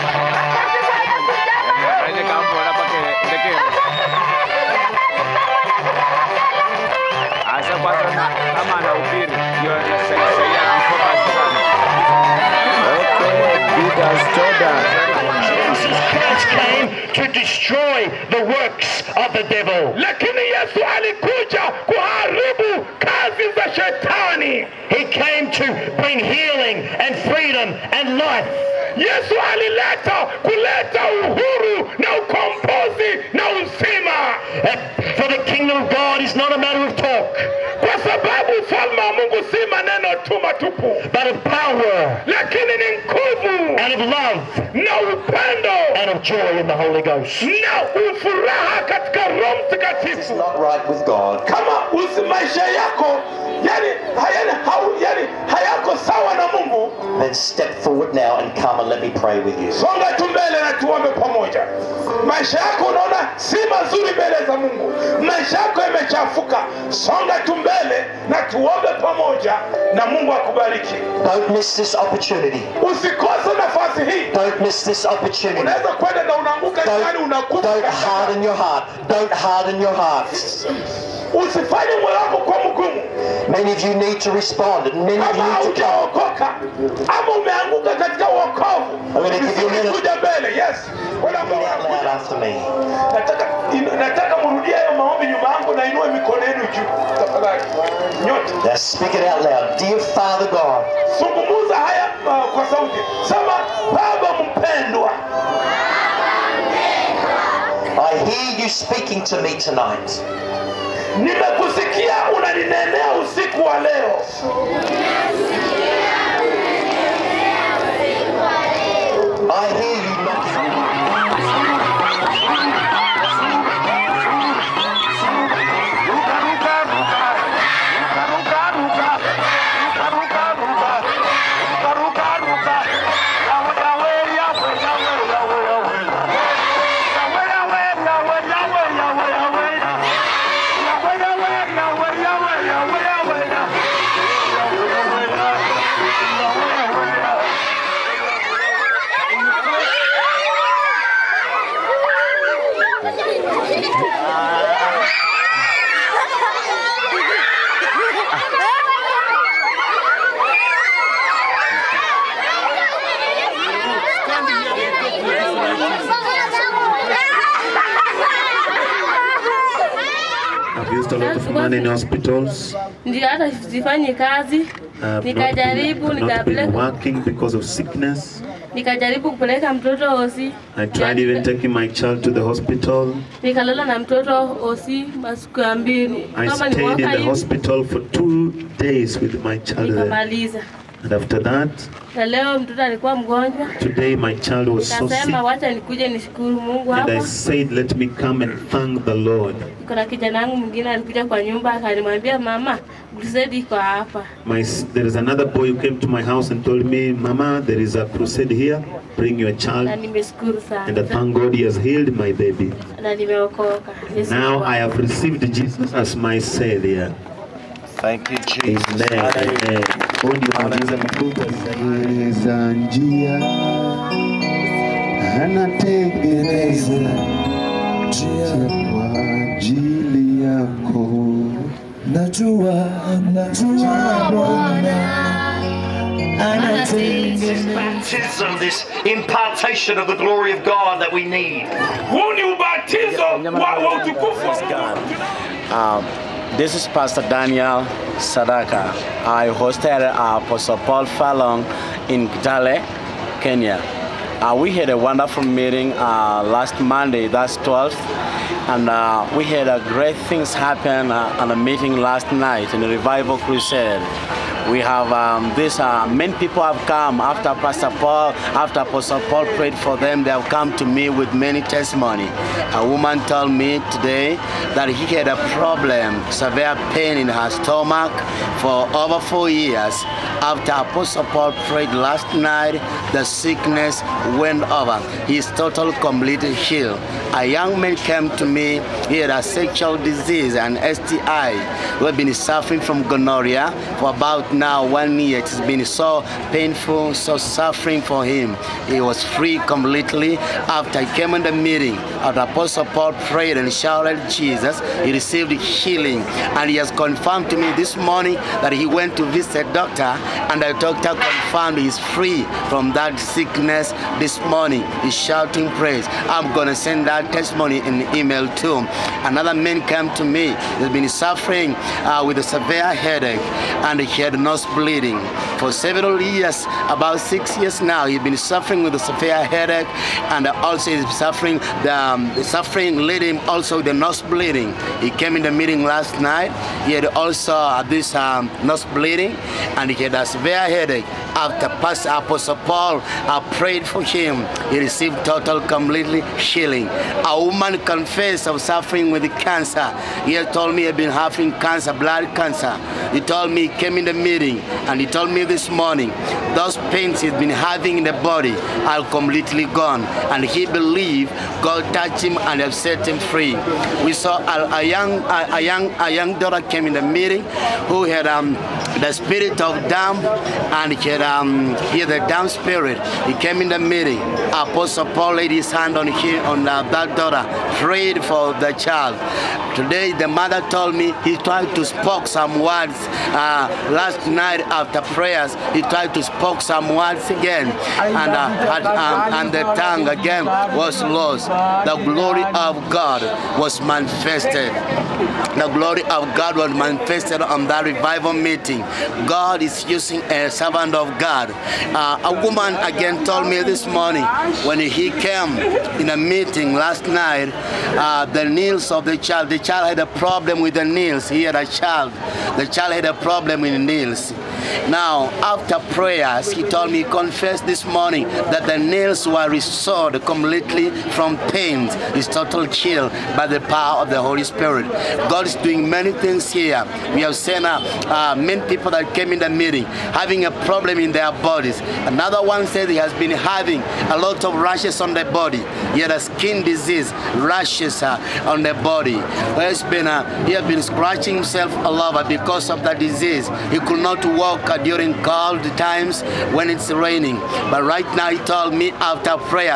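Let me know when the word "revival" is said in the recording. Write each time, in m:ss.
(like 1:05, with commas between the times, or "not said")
4:22, 6:37.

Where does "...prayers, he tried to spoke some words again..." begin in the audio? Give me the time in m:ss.
6:25.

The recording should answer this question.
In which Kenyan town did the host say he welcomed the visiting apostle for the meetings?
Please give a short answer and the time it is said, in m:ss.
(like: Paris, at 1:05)
Kitale, at 4:12.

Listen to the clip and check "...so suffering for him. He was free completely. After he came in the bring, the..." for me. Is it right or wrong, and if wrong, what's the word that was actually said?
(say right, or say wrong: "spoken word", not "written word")
wrong: "meeting", not "bring".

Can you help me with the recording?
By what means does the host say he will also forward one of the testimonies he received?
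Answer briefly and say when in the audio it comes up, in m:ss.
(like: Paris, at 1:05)
Email, at 5:18.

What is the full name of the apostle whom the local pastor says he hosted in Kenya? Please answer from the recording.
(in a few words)
Apostle Paul Furlong.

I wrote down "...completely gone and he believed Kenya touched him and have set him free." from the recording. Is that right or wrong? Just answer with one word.
wrong.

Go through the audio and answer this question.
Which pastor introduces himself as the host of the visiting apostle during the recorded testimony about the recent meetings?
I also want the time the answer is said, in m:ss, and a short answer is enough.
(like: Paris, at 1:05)
Daniel Sadaka, at 4:06.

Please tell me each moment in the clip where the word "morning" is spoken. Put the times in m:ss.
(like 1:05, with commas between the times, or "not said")
5:07, 5:14, 5:55, 6:43, 6:57.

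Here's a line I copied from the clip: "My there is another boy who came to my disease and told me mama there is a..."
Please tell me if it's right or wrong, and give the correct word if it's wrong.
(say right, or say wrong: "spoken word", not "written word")
wrong: "house", not "disease".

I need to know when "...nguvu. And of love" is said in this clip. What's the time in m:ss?
0:43.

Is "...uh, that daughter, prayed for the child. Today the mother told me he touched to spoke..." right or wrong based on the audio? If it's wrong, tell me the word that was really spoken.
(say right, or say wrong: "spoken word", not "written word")
wrong: "tried", not "touched".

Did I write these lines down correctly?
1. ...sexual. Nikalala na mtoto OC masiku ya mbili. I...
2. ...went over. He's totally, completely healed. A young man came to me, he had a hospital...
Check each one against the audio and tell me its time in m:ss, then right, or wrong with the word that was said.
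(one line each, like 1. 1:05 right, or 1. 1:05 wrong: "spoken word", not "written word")
1. 3:02 wrong: "hospital", not "sexual"
2. 4:44 wrong: "sexual", not "hospital".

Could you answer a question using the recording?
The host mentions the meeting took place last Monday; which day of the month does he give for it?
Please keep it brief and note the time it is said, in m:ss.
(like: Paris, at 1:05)
12th, at 4:17.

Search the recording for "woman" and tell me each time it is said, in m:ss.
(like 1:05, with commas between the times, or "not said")
4:32, 5:47, 6:42.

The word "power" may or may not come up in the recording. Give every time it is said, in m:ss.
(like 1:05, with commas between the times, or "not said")
0:41, 7:03.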